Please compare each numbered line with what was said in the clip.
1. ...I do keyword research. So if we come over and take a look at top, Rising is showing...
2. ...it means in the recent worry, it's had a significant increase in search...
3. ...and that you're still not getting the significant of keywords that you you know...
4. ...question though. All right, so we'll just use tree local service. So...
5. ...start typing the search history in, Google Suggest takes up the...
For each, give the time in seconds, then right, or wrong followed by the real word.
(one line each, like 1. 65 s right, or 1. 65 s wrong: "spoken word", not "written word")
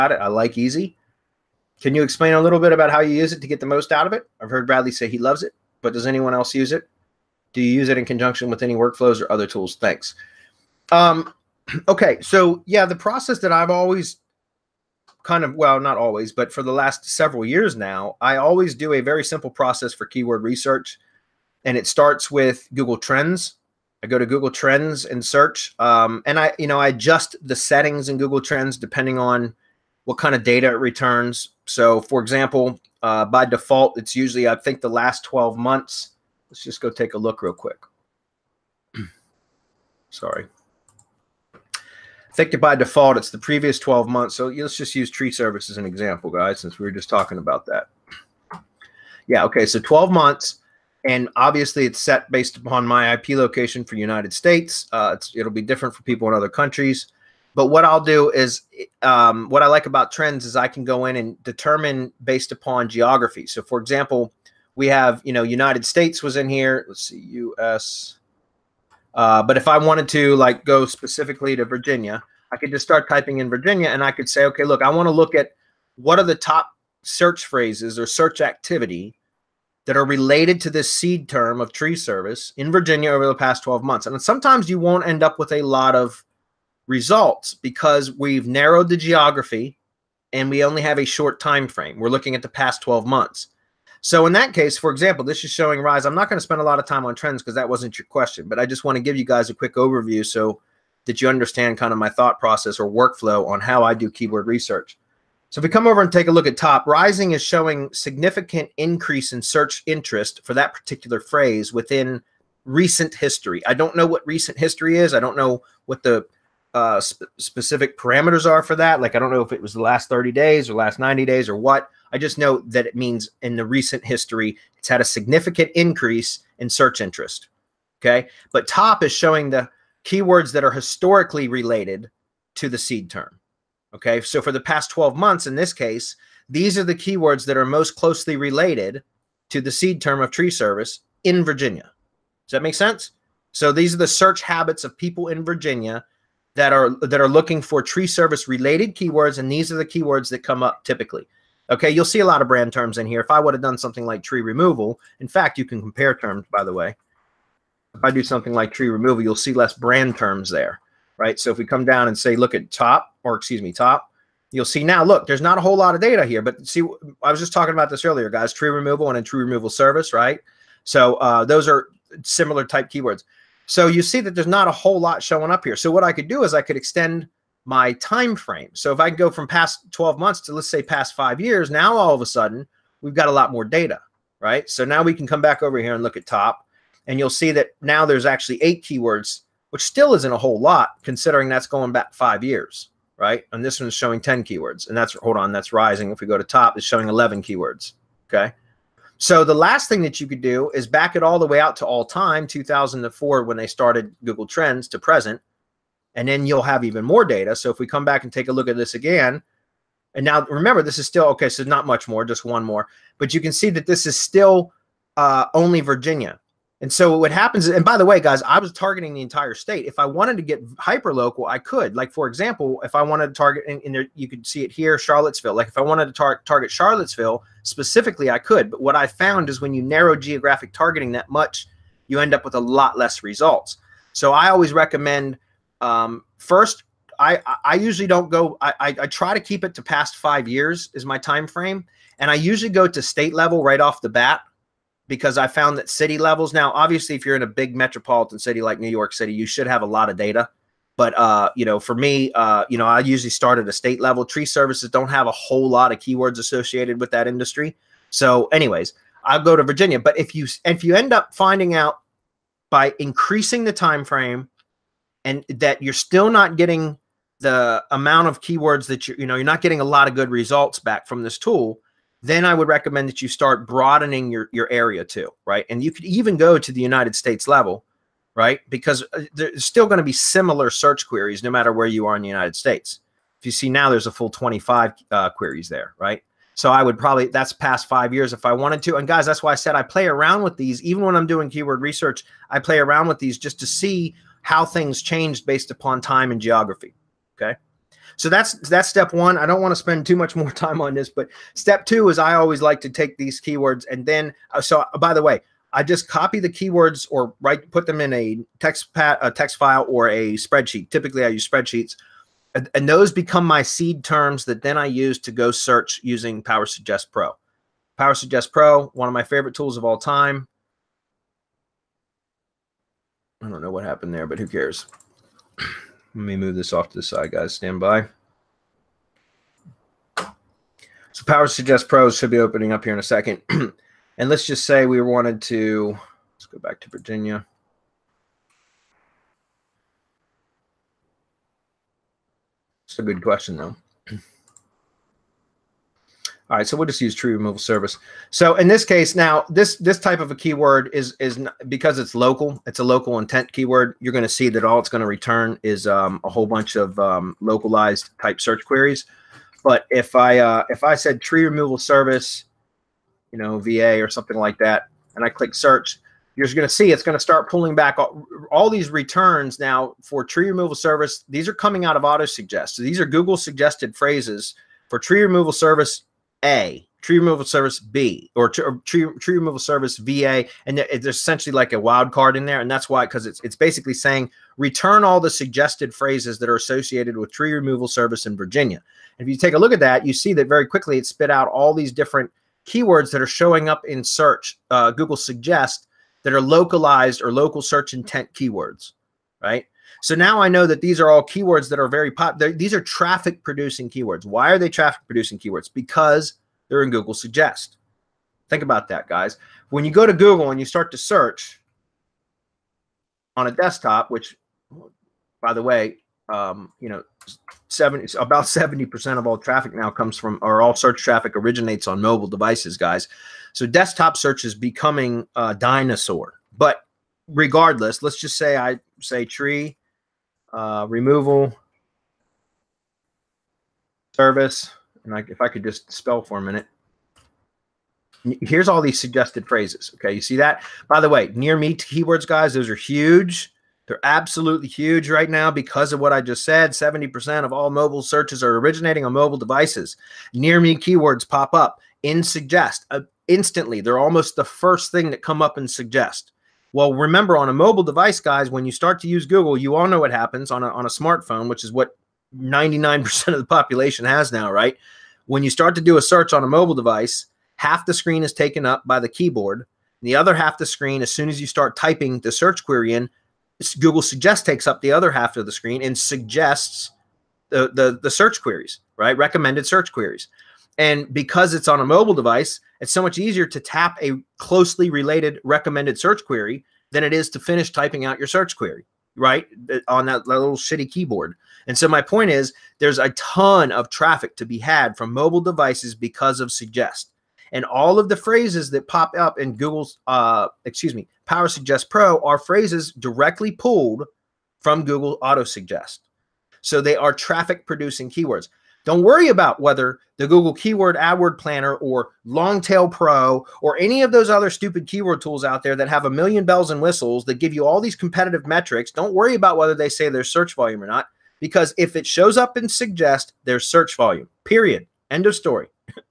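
1. 103 s right
2. 122 s wrong: "history", not "worry"
3. 265 s wrong: "amount", not "significant"
4. 343 s wrong: "removal", not "local"
5. 471 s wrong: "query", not "history".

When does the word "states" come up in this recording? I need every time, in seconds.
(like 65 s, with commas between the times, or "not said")
54 s, 65 s, 219 s, 243 s, 253 s, 277 s, 282 s.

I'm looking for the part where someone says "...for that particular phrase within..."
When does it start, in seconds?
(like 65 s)
110 s.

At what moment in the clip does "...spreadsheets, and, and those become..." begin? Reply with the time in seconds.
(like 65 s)
311 s.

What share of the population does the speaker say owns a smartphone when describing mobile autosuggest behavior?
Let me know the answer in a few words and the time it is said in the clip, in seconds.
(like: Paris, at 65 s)
99%, at 462 s.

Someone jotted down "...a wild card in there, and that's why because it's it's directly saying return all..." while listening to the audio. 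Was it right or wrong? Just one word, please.
wrong.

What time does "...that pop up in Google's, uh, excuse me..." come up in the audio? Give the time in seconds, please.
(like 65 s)
498 s.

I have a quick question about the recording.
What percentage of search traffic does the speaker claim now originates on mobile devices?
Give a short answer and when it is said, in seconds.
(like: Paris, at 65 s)
70%, at 418 s.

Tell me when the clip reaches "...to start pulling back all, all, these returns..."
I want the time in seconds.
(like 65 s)
367 s.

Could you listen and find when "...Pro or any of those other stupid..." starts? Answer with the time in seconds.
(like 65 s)
512 s.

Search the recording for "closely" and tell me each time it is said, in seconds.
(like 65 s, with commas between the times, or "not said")
137 s, 484 s.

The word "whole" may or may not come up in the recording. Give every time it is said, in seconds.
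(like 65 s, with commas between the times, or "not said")
165 s, 174 s, 190 s, 255 s, 356 s.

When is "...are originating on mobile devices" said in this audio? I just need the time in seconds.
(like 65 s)
448 s.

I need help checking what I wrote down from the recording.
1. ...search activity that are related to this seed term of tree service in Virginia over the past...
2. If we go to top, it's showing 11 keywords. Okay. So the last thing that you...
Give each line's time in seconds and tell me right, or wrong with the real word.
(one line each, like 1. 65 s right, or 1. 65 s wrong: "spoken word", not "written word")
1. 78 s right
2. 196 s right.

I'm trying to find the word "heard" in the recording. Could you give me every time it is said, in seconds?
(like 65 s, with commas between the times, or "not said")
4 s.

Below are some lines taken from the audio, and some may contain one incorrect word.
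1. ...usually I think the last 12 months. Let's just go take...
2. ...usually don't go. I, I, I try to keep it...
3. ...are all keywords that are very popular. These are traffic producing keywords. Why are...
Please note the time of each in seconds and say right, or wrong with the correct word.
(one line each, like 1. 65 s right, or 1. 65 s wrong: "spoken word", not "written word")
1. 34 s right
2. 237 s right
3. 401 s right.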